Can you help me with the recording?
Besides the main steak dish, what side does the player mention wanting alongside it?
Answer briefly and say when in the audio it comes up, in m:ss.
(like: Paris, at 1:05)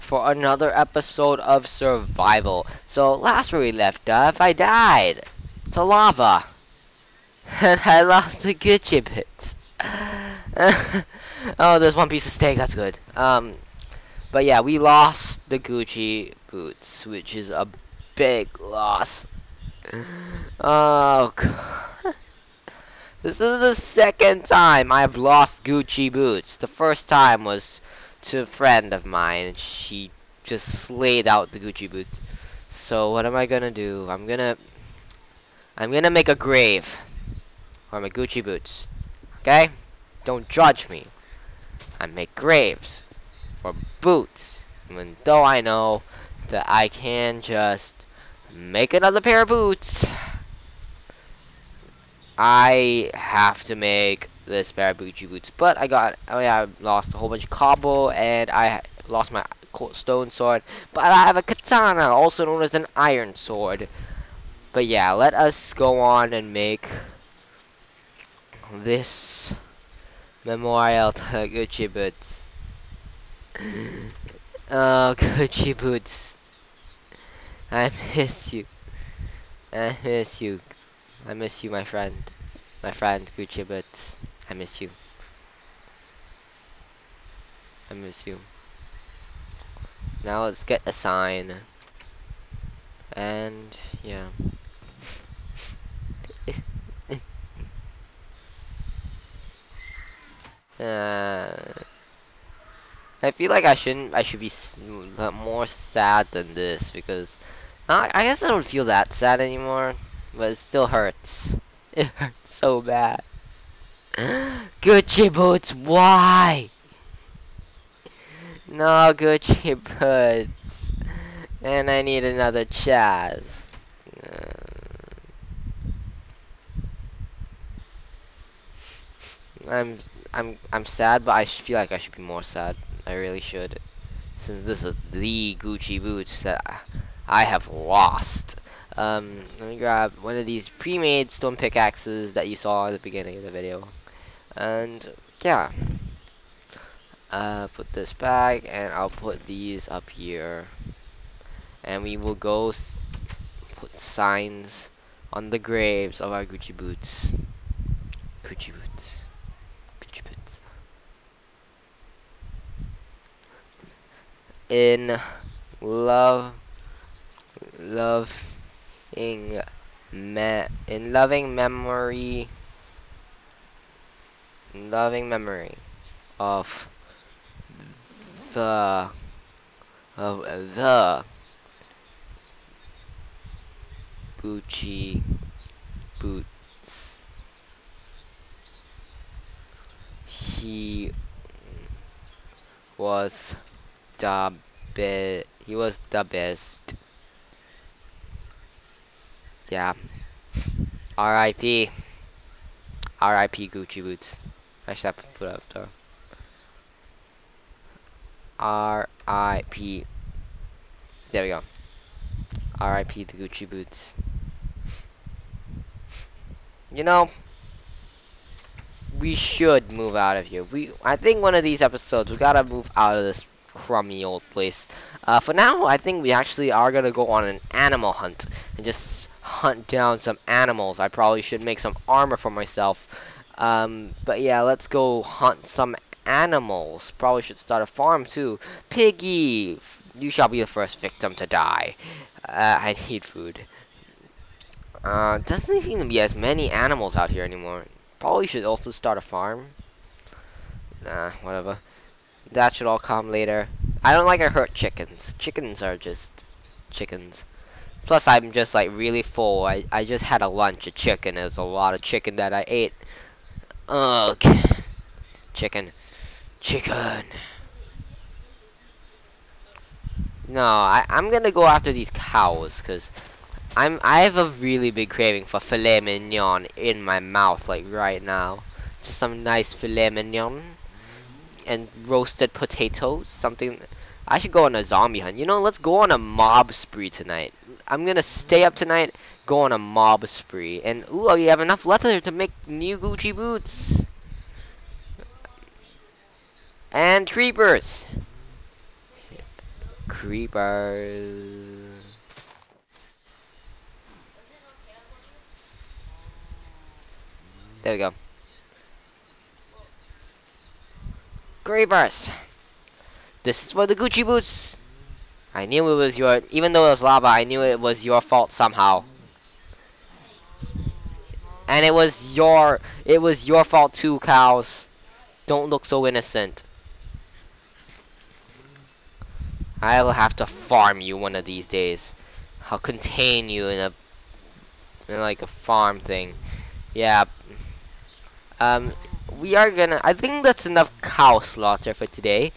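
Roasted potatoes, at 4:42.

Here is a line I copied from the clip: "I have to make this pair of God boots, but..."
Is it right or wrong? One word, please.
wrong.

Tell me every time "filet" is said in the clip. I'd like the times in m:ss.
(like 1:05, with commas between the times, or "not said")
4:35, 4:39.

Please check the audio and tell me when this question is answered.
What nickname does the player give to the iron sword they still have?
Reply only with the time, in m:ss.
1:01.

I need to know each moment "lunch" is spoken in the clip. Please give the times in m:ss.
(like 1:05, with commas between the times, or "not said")
4:20.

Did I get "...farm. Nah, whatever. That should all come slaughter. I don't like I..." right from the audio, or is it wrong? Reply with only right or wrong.
wrong.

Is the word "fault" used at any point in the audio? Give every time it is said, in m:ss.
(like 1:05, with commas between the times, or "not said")
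5:18, 5:23.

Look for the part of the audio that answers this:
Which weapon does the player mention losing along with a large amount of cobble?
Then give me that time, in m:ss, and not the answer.
0:59.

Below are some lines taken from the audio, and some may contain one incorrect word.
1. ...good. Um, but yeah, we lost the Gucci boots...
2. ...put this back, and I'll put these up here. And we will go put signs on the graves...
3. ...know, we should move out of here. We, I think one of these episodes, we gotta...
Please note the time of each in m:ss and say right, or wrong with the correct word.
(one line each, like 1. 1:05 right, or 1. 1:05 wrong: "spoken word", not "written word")
1. 0:12 right
2. 2:27 right
3. 3:37 right.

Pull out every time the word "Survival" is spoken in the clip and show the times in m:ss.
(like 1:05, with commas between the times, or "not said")
0:01.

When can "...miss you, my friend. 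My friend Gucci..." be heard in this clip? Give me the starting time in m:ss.
1:21.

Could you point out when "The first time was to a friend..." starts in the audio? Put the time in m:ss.
0:26.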